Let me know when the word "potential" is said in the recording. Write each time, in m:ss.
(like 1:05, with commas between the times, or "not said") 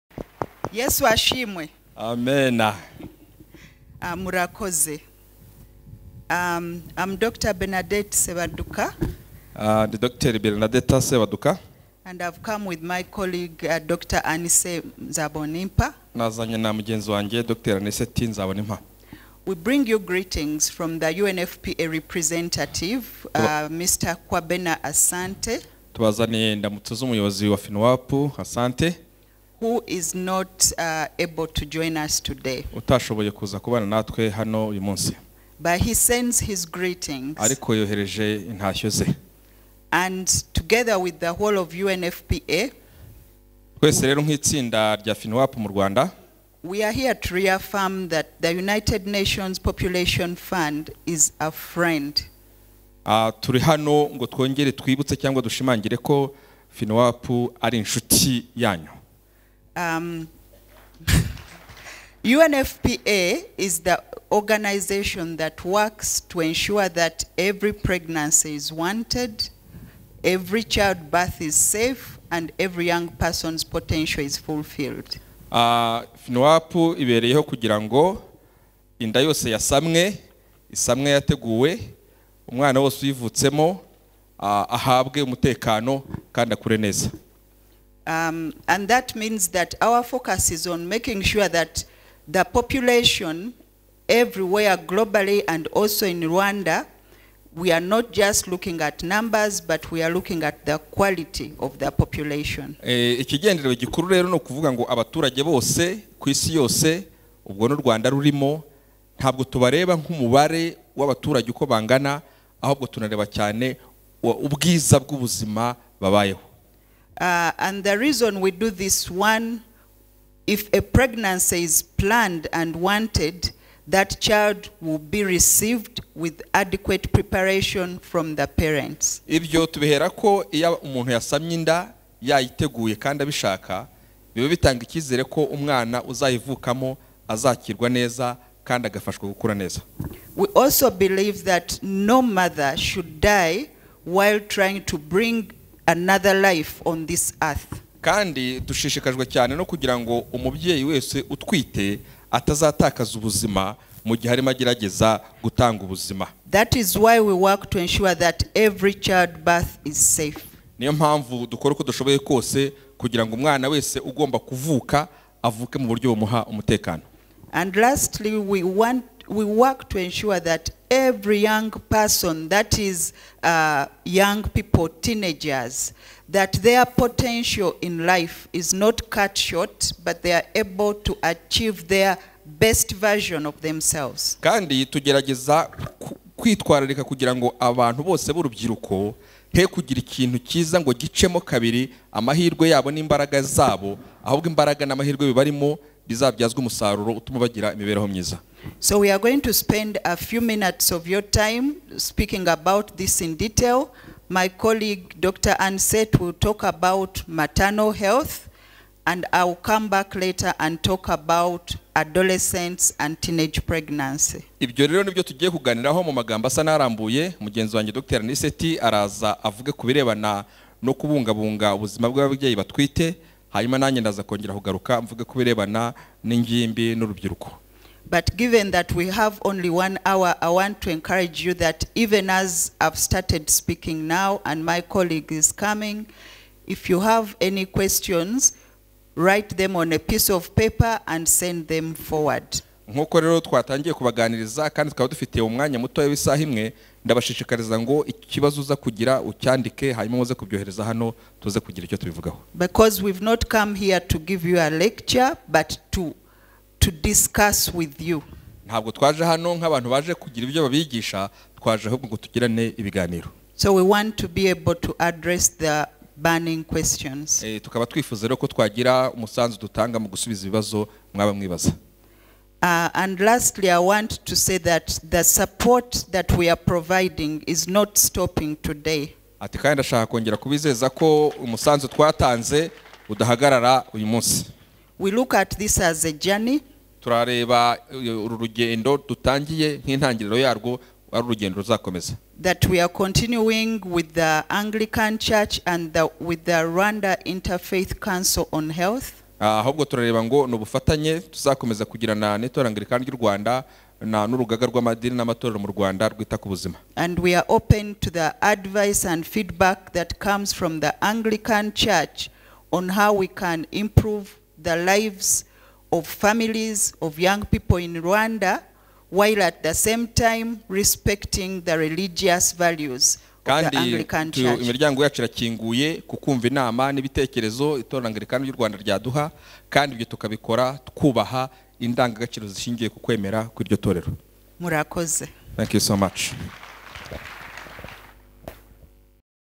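1:13, 2:56.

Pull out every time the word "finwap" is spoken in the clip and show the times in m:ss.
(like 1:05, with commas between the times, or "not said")
0:27, 0:56.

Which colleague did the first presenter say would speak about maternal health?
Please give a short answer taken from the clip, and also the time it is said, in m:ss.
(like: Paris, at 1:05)
Dr. Anicet, at 3:25.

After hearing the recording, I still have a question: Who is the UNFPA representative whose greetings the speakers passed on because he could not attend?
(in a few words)
Kwabena Asante.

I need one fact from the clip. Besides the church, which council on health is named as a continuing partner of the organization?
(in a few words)
Rwanda Interfaith Council on Health.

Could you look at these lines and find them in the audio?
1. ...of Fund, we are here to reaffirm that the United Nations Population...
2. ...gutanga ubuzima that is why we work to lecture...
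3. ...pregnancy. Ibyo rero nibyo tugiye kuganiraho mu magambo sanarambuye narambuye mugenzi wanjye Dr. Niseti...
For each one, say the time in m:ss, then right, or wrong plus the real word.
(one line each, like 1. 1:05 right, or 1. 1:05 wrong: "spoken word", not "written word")
1. 0:41 wrong: "UNFPA", not "Fund"
2. 2:35 wrong: "ensure", not "lecture"
3. 3:33 right.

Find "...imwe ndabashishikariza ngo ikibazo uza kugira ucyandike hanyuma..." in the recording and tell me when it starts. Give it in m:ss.
4:06.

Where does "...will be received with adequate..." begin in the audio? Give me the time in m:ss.
2:04.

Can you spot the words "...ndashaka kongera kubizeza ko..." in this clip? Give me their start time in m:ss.
4:39.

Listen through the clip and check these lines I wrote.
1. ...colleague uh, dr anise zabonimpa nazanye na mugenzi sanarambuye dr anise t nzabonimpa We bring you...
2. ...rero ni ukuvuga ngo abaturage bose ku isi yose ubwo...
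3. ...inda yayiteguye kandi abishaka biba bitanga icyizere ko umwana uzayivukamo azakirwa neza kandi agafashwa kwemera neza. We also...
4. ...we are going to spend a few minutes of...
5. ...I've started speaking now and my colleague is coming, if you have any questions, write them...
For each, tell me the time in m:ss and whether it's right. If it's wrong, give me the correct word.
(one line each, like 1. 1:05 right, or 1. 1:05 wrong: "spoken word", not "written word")
1. 0:13 wrong: "wanjye", not "sanarambuye"
2. 1:44 right
3. 2:11 wrong: "gukura", not "kwemera"
4. 3:19 right
5. 3:52 right.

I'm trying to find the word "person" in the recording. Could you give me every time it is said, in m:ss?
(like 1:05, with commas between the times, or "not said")
1:13, 2:51.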